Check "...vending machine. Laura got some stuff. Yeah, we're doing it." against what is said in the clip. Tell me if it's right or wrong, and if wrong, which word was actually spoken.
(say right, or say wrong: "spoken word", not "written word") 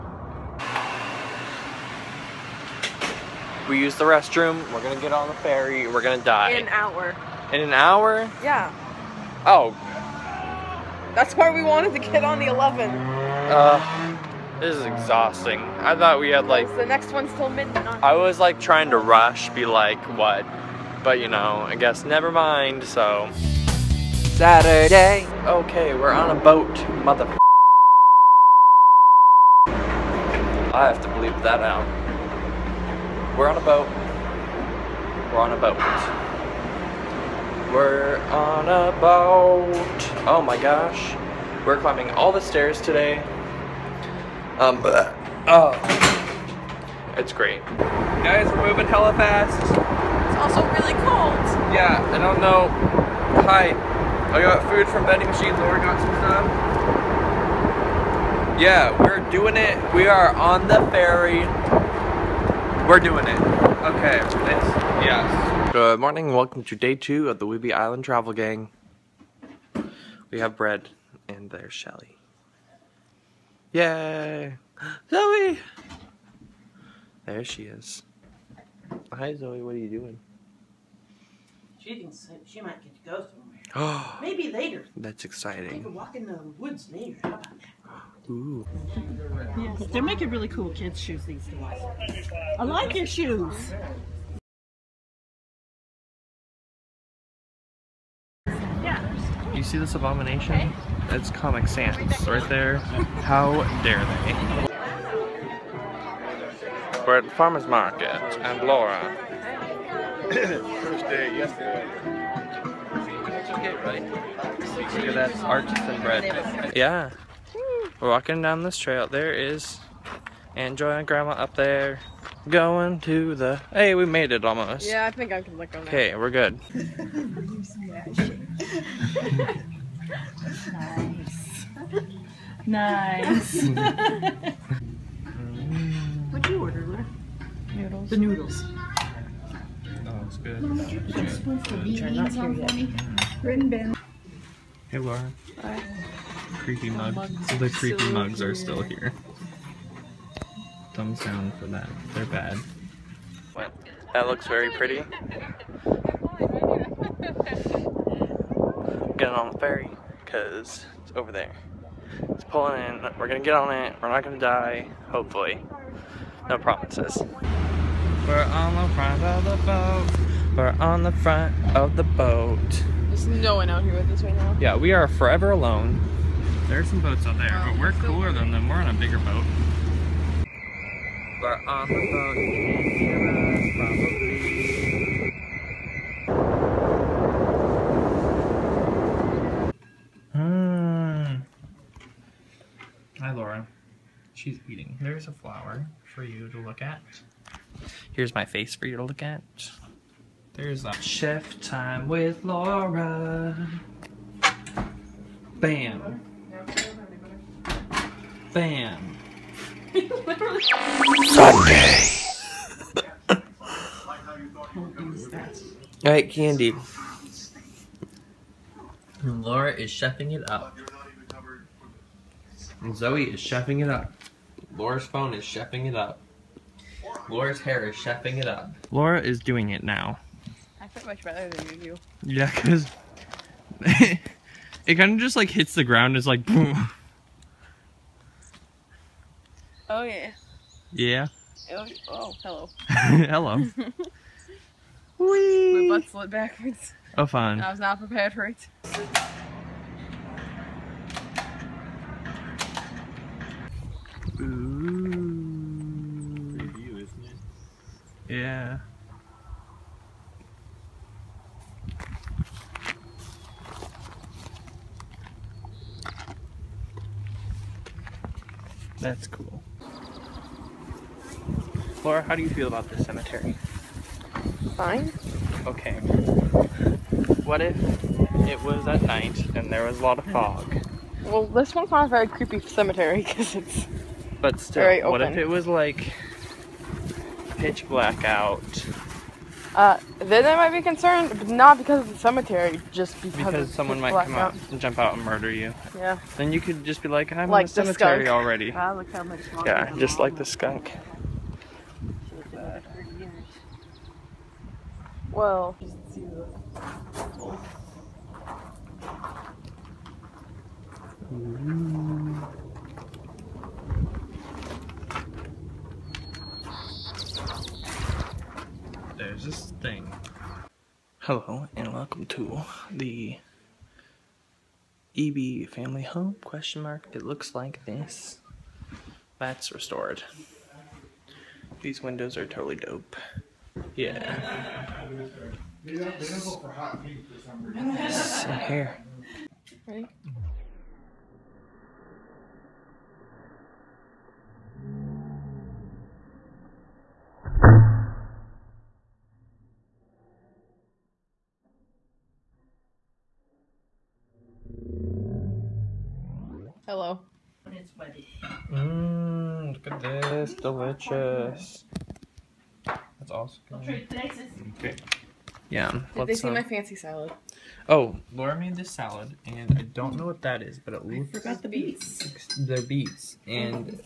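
right.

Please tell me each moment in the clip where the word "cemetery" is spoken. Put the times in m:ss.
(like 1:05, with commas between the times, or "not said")
4:33, 4:42, 4:52, 4:57.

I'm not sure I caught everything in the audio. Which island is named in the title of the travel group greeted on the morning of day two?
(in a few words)
Whidbey Island.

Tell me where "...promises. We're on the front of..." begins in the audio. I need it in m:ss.
2:46.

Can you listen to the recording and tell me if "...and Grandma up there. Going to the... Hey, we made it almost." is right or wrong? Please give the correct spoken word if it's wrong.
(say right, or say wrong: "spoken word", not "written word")
right.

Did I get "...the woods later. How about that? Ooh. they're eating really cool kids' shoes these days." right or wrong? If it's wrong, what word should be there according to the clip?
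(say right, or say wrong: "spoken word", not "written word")
wrong: "making", not "eating".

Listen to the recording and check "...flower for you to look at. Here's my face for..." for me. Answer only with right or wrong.
right.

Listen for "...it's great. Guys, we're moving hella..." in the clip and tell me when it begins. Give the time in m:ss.
0:47.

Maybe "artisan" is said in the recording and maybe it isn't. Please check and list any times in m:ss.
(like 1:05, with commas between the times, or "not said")
1:55.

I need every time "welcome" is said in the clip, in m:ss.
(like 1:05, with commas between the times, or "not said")
1:06, 5:21.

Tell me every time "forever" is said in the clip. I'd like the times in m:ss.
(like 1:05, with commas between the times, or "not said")
2:55.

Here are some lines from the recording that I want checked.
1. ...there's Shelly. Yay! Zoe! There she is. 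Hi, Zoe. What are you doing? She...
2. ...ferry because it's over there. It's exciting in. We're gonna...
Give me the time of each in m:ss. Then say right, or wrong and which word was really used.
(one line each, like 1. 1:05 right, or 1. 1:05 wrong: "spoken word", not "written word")
1. 1:11 right
2. 2:39 wrong: "pulling", not "exciting".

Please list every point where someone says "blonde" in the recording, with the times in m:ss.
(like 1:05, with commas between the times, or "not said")
not said.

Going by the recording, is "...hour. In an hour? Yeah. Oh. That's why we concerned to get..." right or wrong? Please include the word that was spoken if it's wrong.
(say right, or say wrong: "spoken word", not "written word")
wrong: "wanted", not "concerned".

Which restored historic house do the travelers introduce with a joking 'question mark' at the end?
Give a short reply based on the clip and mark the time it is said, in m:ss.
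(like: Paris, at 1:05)
Ebey Family Home, at 5:25.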